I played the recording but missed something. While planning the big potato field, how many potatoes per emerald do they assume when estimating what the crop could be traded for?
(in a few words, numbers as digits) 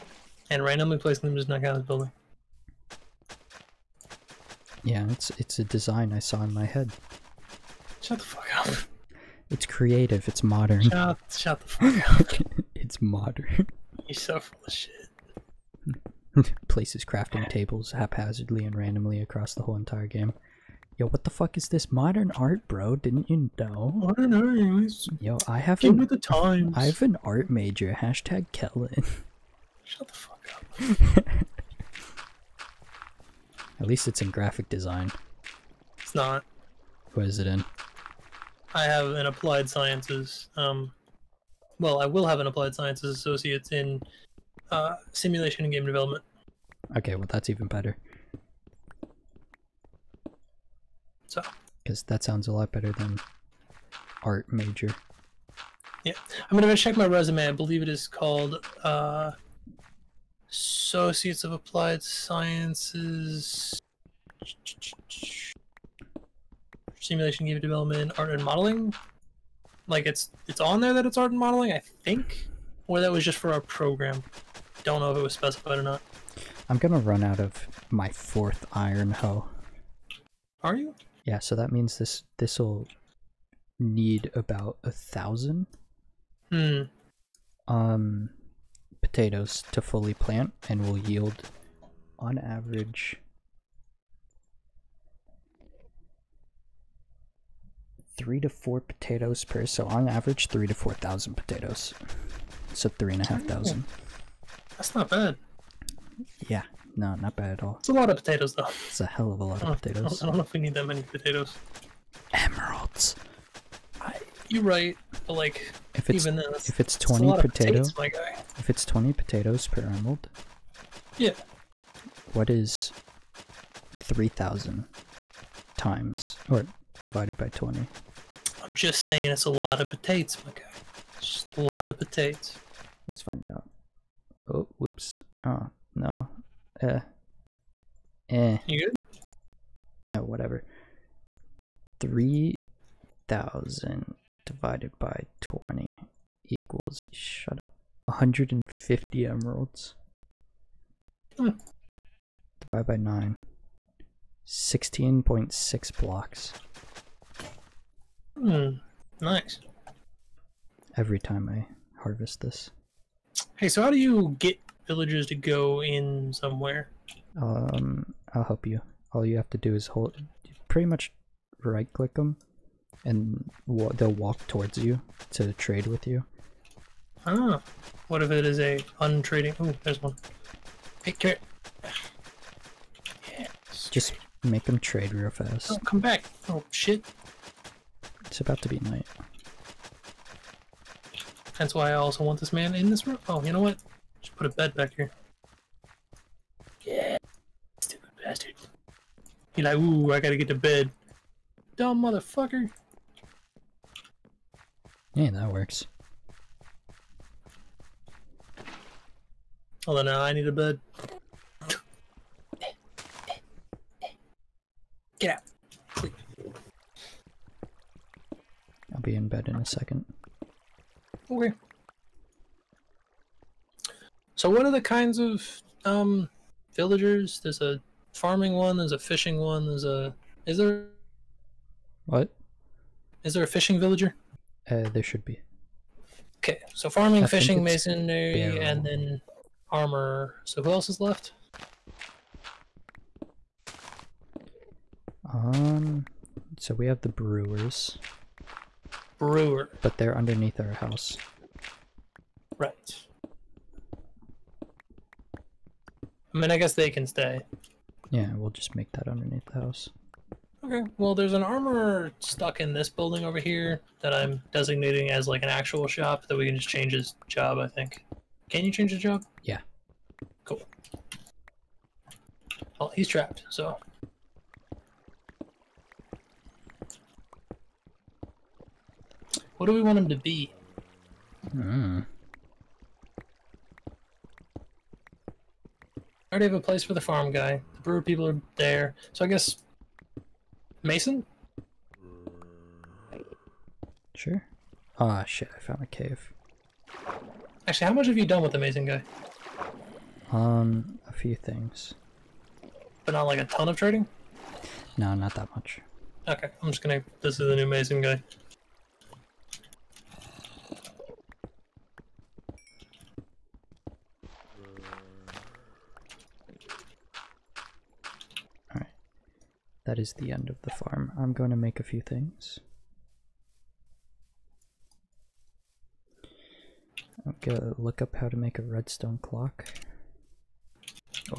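20.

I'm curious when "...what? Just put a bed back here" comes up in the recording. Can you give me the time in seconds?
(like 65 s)
193 s.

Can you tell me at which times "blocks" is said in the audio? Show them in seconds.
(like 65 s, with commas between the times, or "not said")
155 s.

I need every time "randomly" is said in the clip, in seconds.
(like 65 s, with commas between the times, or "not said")
0 s, 18 s.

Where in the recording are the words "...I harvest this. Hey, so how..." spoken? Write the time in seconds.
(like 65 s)
161 s.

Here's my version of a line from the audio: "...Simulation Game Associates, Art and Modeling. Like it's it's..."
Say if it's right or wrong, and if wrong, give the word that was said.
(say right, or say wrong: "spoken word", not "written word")
wrong: "Development", not "Associates".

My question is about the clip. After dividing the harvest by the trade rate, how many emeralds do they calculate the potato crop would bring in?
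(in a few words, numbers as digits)
150.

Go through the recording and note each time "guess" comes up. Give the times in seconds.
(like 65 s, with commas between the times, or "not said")
256 s, 289 s.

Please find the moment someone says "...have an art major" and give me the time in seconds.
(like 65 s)
26 s.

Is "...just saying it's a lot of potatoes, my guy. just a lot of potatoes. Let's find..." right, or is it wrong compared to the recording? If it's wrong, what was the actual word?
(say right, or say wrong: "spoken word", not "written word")
right.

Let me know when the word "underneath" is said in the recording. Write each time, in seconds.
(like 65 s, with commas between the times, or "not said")
250 s, 259 s.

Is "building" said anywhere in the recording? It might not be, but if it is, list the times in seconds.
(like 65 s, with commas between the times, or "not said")
1 s, 262 s.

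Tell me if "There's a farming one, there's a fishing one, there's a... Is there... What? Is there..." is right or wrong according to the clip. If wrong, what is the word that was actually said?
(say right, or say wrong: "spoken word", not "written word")
right.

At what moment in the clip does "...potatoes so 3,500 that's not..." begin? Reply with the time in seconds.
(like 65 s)
101 s.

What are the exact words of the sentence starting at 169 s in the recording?
All you have to do is hold, pretty much right click them and they'll walk towards you to trade with you.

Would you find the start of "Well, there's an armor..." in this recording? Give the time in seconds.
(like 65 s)
260 s.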